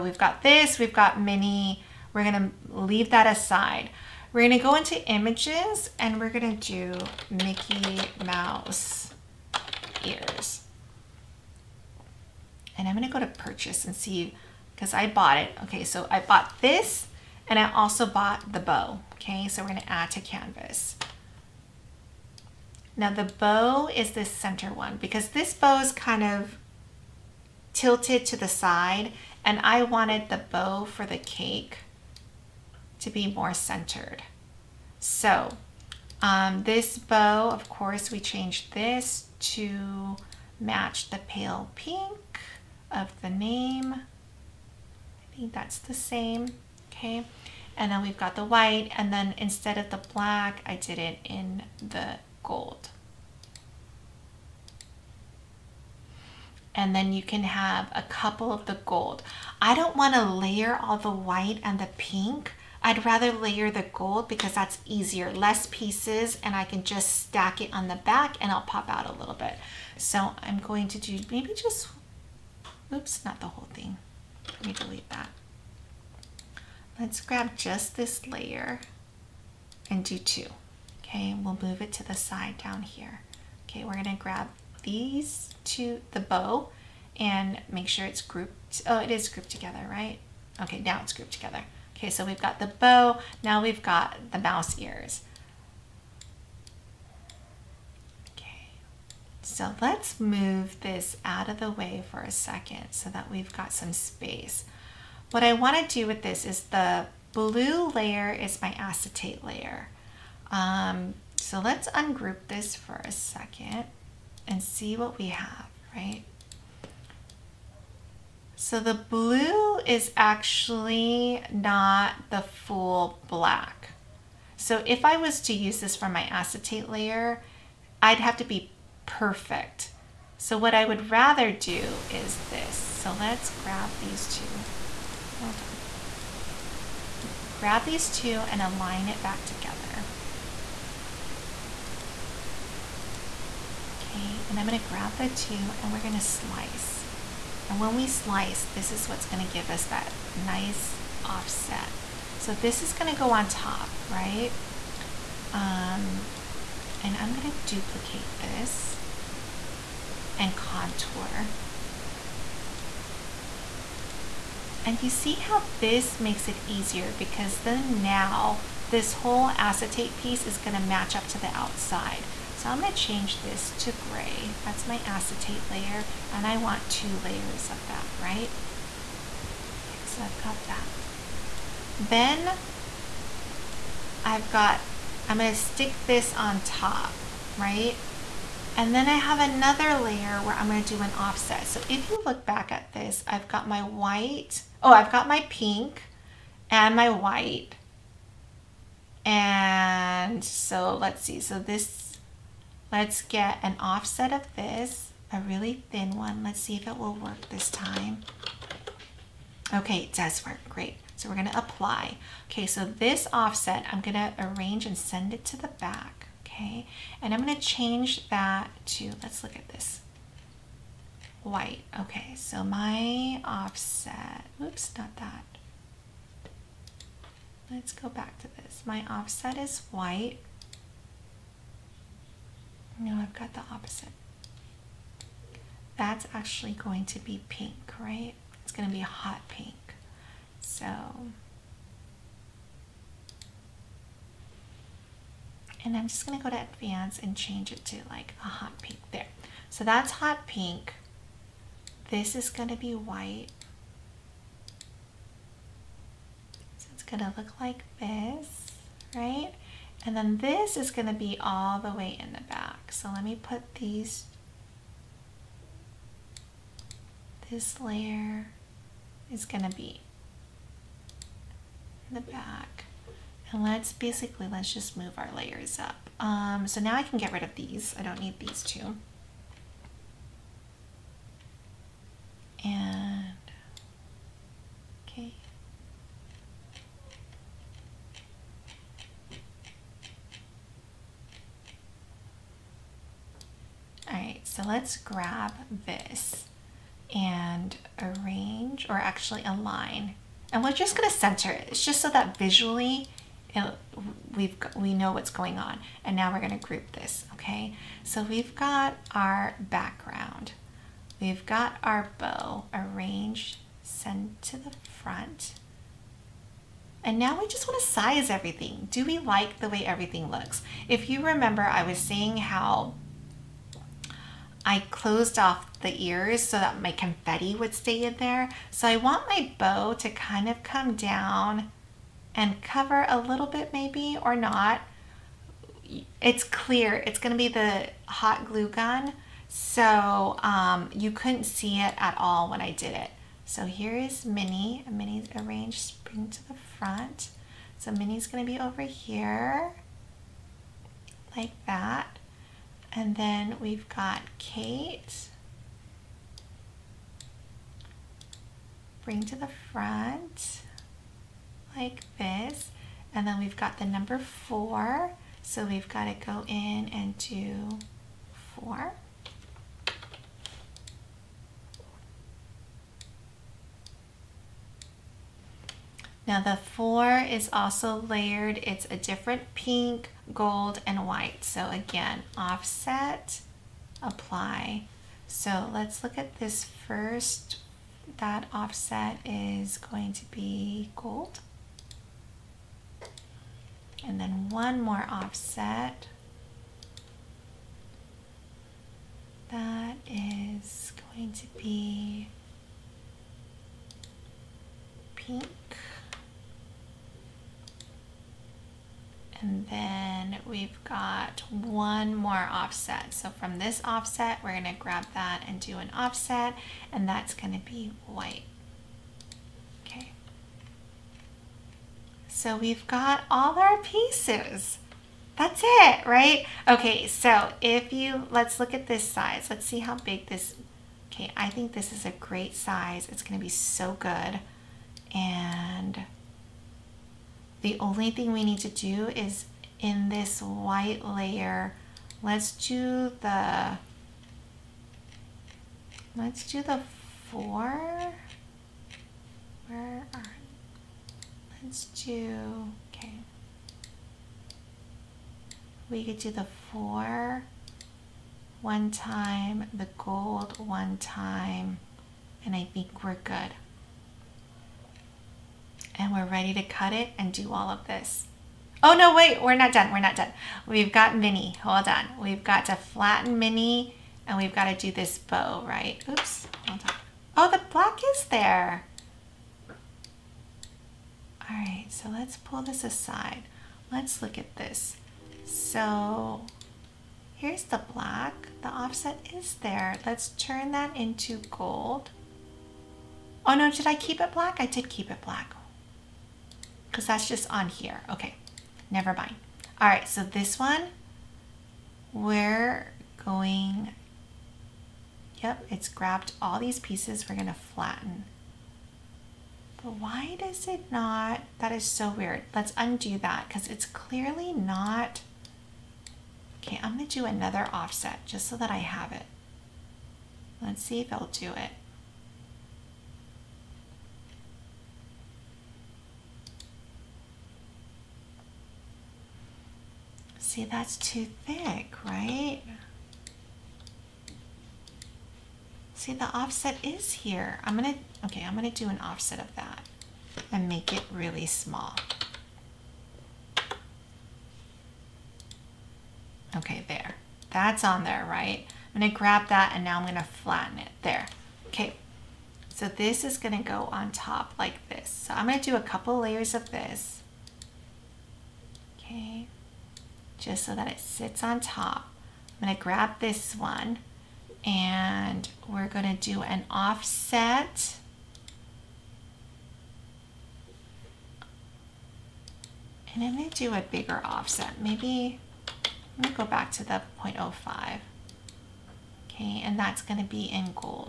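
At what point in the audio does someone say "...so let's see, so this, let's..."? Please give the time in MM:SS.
03:20.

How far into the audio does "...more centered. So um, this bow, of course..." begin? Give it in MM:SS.
00:33.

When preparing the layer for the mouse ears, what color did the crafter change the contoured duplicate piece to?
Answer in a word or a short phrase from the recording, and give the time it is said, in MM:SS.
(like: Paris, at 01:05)
gray, at 02:52.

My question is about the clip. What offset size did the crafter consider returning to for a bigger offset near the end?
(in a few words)
0.05.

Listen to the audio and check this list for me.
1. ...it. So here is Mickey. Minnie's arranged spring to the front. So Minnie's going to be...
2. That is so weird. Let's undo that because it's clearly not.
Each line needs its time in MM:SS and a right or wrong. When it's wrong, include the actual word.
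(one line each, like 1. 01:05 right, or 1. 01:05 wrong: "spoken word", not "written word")
1. 05:42 wrong: "Minnie", not "Mickey"
2. 08:31 right.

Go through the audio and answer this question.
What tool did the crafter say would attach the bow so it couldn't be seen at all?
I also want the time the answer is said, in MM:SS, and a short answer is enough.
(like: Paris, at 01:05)
hot glue gun, at 05:37.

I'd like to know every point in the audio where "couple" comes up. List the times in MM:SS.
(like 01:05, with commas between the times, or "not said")
00:58, 09:15.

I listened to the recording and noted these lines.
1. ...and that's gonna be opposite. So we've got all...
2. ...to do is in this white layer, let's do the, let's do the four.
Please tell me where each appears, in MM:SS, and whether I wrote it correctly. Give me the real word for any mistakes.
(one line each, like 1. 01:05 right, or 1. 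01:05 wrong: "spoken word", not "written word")
1. 06:56 wrong: "white", not "opposite"
2. 07:18 right.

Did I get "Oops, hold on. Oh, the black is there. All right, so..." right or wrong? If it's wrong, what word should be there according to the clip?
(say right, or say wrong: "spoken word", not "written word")
right.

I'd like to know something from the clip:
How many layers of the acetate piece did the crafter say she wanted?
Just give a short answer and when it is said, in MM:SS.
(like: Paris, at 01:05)
2, at 02:56.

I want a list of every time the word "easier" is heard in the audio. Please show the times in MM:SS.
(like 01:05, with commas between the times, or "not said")
01:04, 02:46.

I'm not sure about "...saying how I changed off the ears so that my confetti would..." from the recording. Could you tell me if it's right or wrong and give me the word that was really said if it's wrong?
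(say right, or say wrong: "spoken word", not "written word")
wrong: "closed", not "changed".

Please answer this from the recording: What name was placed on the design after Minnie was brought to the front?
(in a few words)
Kate.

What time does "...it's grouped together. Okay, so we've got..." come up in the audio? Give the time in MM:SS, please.
01:31.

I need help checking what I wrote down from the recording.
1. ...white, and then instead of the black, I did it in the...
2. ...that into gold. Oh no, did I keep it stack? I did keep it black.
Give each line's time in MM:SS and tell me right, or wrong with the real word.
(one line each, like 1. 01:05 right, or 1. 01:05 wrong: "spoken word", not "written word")
1. 00:48 right
2. 08:10 wrong: "black", not "stack".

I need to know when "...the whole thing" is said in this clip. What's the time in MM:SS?
01:13.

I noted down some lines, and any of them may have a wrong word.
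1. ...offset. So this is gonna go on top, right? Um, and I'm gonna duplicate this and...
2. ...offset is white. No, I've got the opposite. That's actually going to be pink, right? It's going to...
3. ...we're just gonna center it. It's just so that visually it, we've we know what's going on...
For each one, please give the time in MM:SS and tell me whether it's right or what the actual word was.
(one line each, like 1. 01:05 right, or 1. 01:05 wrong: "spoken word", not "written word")
1. 02:31 right
2. 03:49 right
3. 05:00 right.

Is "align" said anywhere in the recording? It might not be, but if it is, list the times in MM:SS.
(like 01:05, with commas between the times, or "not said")
02:18, 04:59.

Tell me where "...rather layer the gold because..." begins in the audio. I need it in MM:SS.
01:03.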